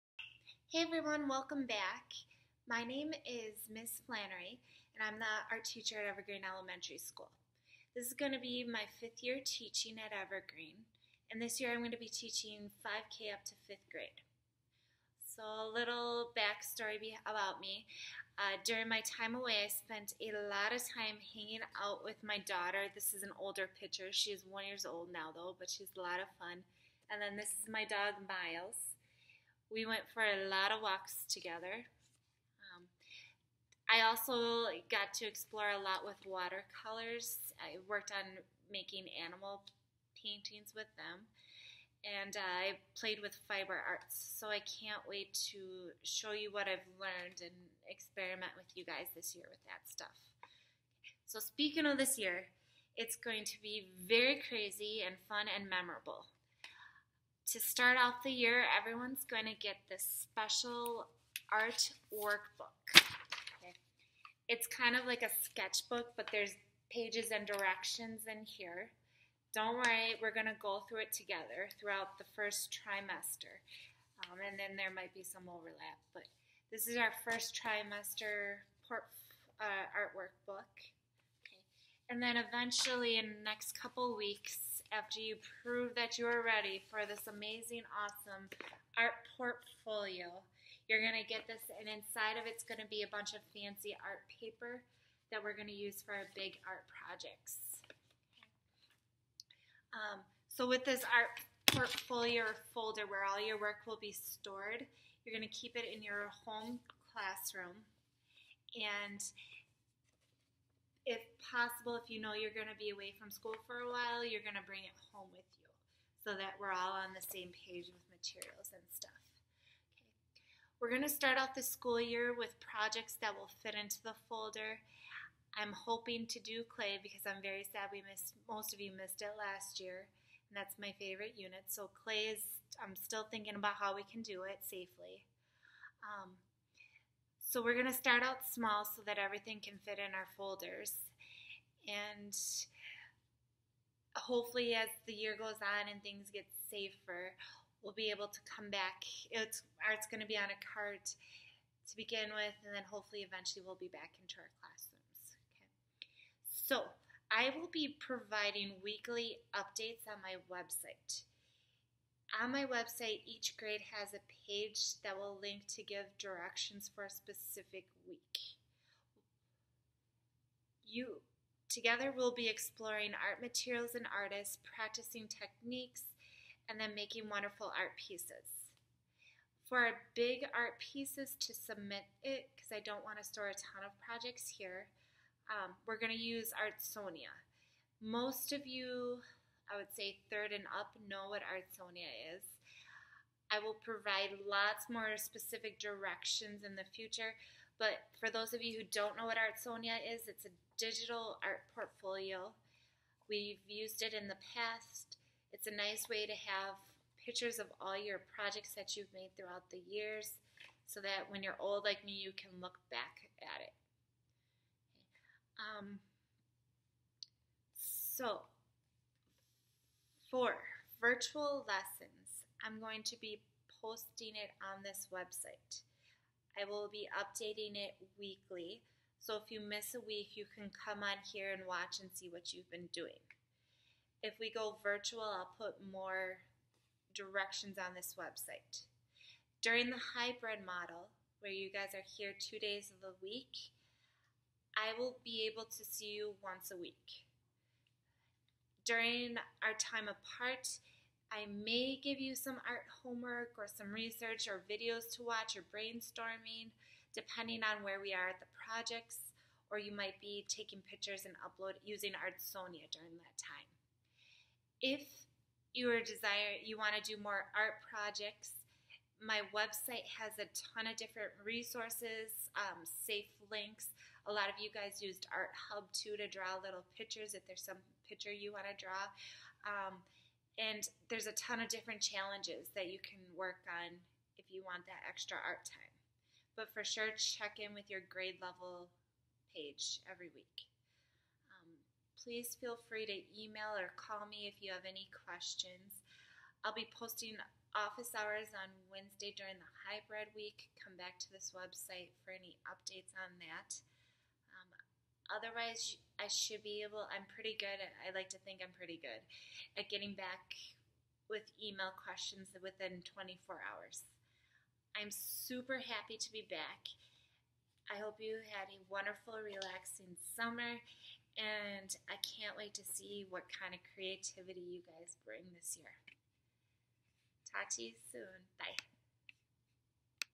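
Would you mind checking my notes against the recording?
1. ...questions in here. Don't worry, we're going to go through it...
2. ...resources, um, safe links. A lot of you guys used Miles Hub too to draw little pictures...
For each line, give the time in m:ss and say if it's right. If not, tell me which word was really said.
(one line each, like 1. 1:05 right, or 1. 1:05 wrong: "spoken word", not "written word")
1. 1:07 wrong: "directions", not "questions"
2. 4:31 wrong: "Art", not "Miles".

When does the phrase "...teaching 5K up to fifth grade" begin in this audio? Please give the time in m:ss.
0:12.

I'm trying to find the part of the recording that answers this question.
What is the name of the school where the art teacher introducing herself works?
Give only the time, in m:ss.
0:06.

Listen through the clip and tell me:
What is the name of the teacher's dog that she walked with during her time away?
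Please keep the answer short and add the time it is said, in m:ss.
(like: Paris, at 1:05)
Miles, at 0:28.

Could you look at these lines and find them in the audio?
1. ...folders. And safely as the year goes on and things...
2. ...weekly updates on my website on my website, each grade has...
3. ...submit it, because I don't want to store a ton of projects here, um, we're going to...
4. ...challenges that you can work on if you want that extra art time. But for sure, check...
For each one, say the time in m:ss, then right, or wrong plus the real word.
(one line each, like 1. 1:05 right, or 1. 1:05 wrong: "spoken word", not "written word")
1. 2:20 wrong: "hopefully", not "safely"
2. 2:38 right
3. 3:01 right
4. 4:42 right.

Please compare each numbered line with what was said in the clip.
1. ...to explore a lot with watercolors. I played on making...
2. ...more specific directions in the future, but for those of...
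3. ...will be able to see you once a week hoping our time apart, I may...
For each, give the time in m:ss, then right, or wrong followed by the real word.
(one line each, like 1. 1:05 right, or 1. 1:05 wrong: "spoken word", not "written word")
1. 0:35 wrong: "worked", not "played"
2. 3:14 right
3. 4:04 wrong: "during", not "hoping".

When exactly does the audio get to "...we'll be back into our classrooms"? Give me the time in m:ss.
2:33.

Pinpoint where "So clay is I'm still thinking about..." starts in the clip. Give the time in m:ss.
2:11.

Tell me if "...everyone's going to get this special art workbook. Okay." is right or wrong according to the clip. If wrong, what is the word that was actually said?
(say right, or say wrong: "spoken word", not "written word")
right.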